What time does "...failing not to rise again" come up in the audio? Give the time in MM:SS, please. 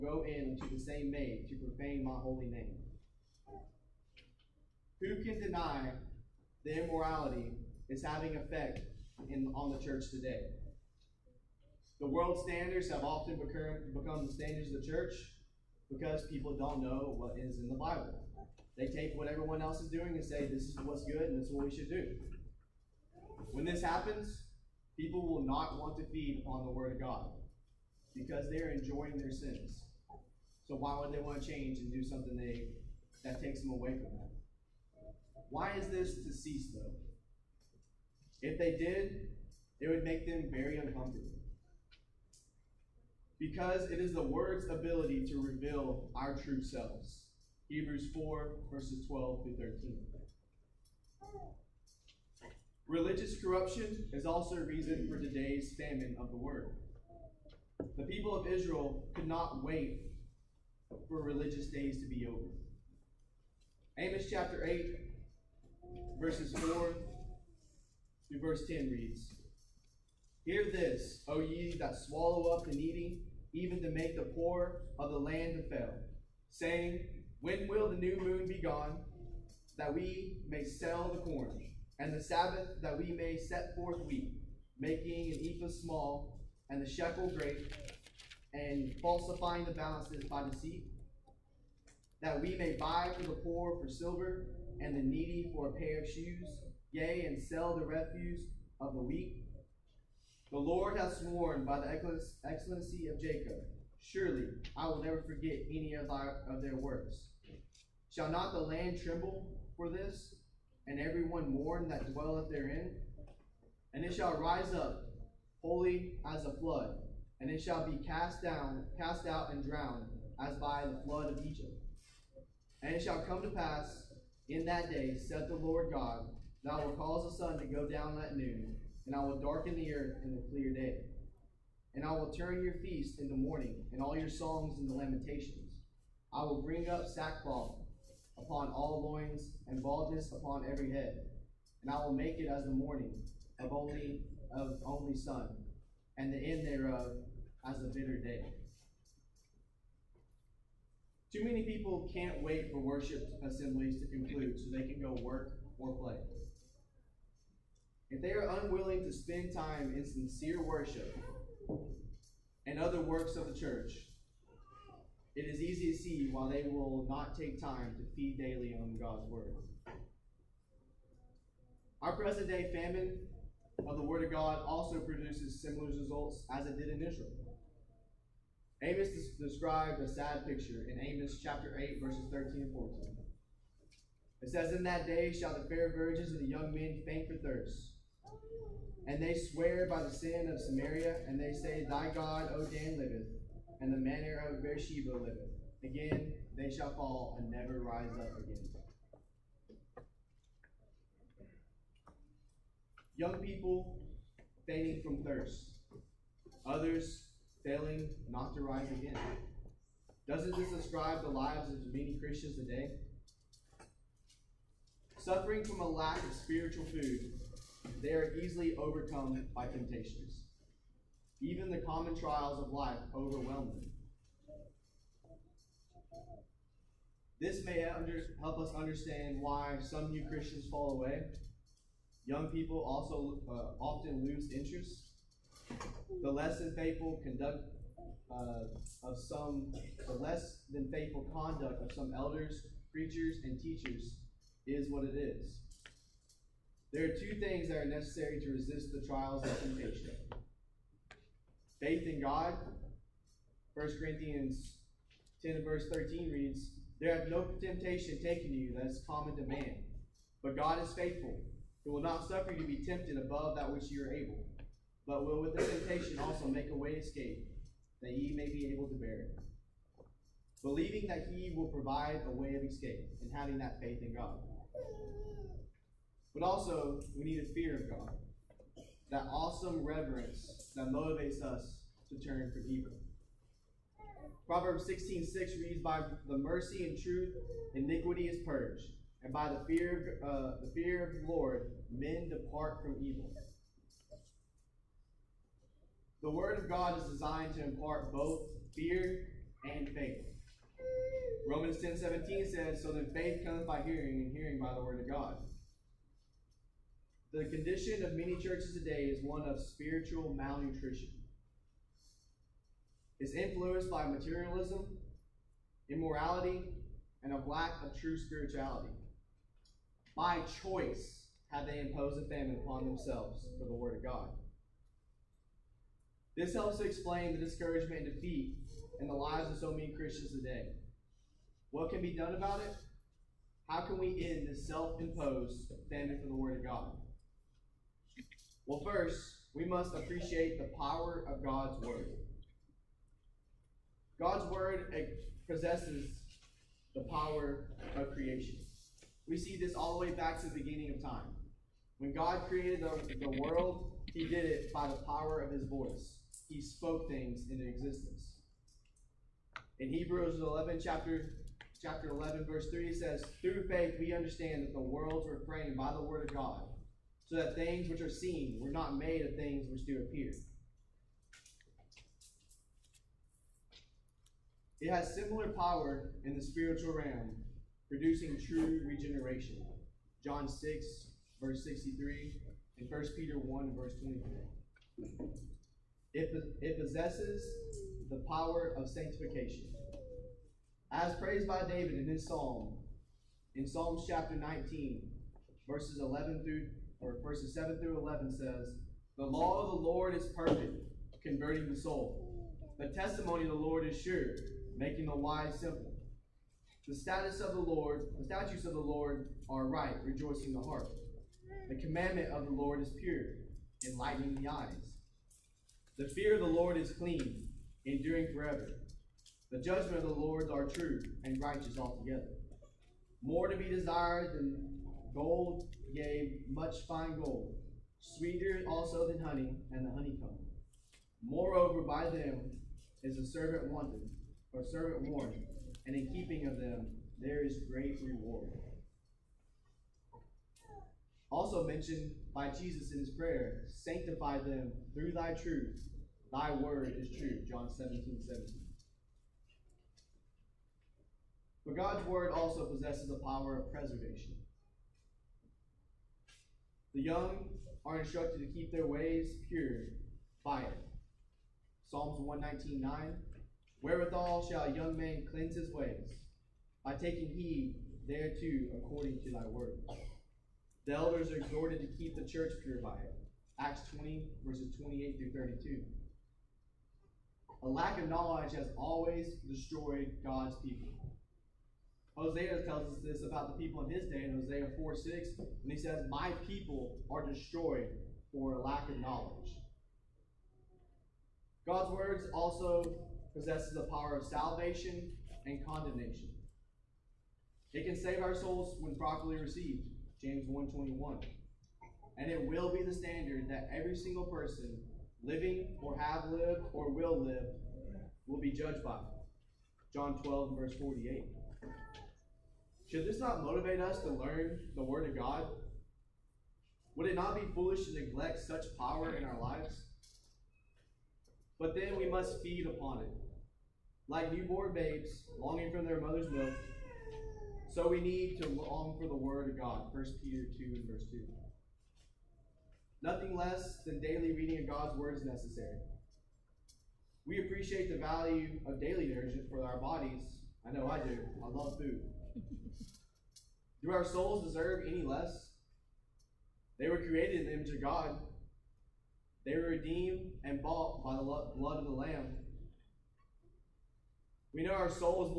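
03:27.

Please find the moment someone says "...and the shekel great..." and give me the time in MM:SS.
01:26.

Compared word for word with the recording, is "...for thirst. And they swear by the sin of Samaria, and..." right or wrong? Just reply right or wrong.
right.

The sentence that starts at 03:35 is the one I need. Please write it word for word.
Suffering from a lack of spiritual food, they are easily overcome by temptations.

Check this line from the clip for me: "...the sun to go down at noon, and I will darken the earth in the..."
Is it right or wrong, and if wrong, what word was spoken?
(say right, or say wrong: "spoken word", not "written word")
right.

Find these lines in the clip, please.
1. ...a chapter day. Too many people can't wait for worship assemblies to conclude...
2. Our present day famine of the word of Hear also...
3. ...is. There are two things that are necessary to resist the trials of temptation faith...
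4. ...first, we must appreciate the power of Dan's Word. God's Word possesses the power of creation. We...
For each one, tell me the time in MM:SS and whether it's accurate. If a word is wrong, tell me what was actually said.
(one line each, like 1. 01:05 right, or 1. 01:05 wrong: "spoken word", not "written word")
1. 02:27 wrong: "bitter", not "chapter"
2. 02:52 wrong: "God", not "Hear"
3. 04:05 right
4. 05:38 wrong: "God", not "Dan".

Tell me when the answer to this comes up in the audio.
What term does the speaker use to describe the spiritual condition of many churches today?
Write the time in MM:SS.
05:09.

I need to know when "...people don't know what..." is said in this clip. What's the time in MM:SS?
00:16.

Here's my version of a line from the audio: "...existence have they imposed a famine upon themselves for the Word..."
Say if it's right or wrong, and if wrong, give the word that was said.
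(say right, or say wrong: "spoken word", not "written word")
wrong: "choice", not "existence".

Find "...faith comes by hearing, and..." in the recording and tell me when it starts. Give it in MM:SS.
05:03.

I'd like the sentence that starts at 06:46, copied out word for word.
The status of the Lord, the statutes of the Lord are right, rejoicing the heart.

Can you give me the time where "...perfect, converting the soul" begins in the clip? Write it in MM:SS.
06:40.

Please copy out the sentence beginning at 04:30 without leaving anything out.
Believing that he will provide a way of escape, and having that faith in God.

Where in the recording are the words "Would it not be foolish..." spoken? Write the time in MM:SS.
08:36.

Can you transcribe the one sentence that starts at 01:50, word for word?
and everyone mourn that dwelleth therein.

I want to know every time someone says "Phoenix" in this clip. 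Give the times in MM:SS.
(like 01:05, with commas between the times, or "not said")
not said.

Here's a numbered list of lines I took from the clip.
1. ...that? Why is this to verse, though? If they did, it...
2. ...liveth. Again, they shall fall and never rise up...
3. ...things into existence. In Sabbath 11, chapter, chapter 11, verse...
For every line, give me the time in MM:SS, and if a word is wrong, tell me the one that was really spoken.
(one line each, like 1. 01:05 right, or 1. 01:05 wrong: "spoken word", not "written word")
1. 00:34 wrong: "cease", not "verse"
2. 03:15 right
3. 05:57 wrong: "Hebrews", not "Sabbath".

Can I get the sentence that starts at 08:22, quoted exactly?
And it will be the standard that every single person living or have lived or will live will be judged by.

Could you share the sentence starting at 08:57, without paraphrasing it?
We appreciate the value of daily nourishment for our bodies.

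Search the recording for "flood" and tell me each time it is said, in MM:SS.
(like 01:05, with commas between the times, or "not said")
01:56, 02:01.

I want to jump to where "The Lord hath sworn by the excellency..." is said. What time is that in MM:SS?
01:40.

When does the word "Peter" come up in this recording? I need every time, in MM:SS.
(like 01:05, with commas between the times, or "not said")
06:23, 08:50.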